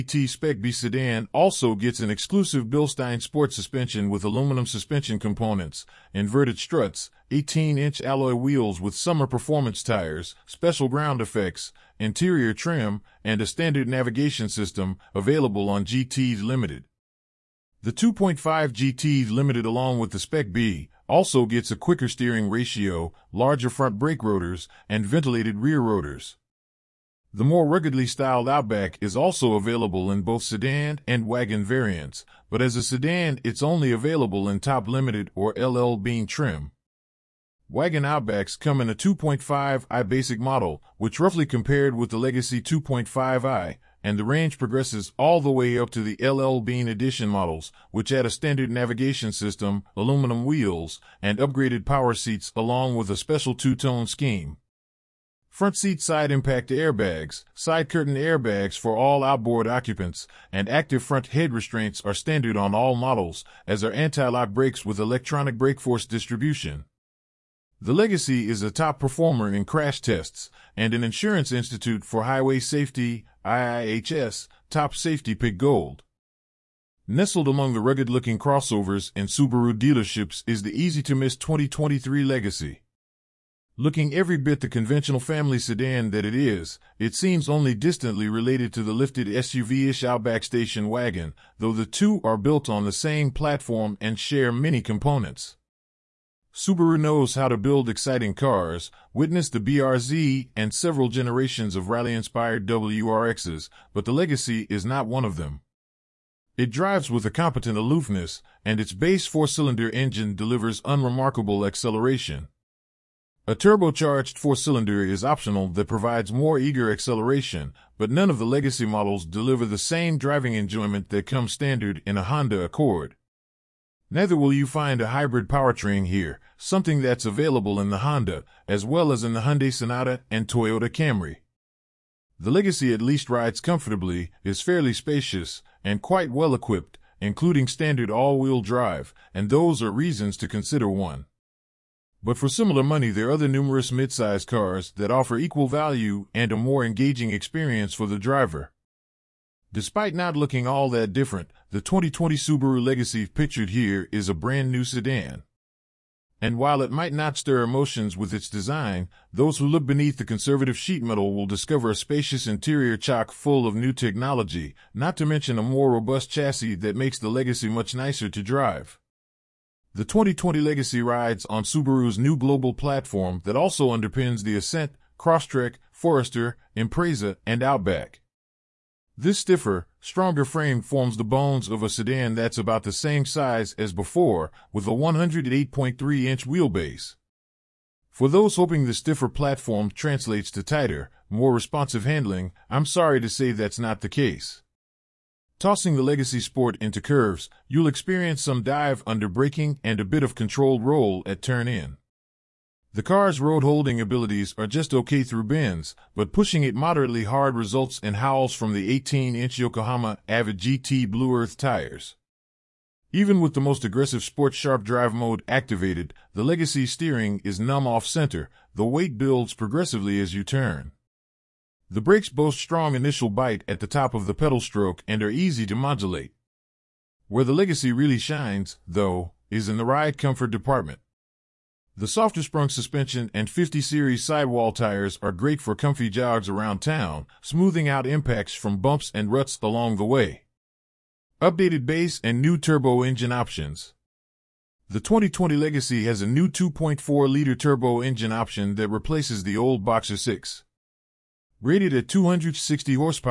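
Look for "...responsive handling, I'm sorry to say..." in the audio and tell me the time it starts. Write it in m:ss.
3:11.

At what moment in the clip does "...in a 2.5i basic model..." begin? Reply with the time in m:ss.
0:38.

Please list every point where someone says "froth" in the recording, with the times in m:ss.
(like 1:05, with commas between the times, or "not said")
not said.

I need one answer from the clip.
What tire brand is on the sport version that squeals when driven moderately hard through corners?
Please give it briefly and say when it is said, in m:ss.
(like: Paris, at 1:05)
Yokohama, at 3:29.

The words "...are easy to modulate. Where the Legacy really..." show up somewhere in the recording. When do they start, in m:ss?
3:45.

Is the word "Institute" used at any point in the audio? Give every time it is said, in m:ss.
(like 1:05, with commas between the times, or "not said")
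1:11.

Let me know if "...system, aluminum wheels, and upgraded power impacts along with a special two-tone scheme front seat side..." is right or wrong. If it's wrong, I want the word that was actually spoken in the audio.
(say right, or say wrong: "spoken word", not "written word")
wrong: "seats", not "impacts".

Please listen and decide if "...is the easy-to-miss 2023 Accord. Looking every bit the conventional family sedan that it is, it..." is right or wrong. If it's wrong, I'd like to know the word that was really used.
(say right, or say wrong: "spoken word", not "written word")
wrong: "Legacy", not "Accord".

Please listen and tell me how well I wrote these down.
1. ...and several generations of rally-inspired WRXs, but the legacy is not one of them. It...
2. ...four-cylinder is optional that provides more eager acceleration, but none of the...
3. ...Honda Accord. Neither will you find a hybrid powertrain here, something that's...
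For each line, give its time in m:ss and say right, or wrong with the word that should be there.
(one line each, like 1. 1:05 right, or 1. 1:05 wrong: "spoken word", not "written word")
1. 1:40 right
2. 1:54 right
3. 2:02 right.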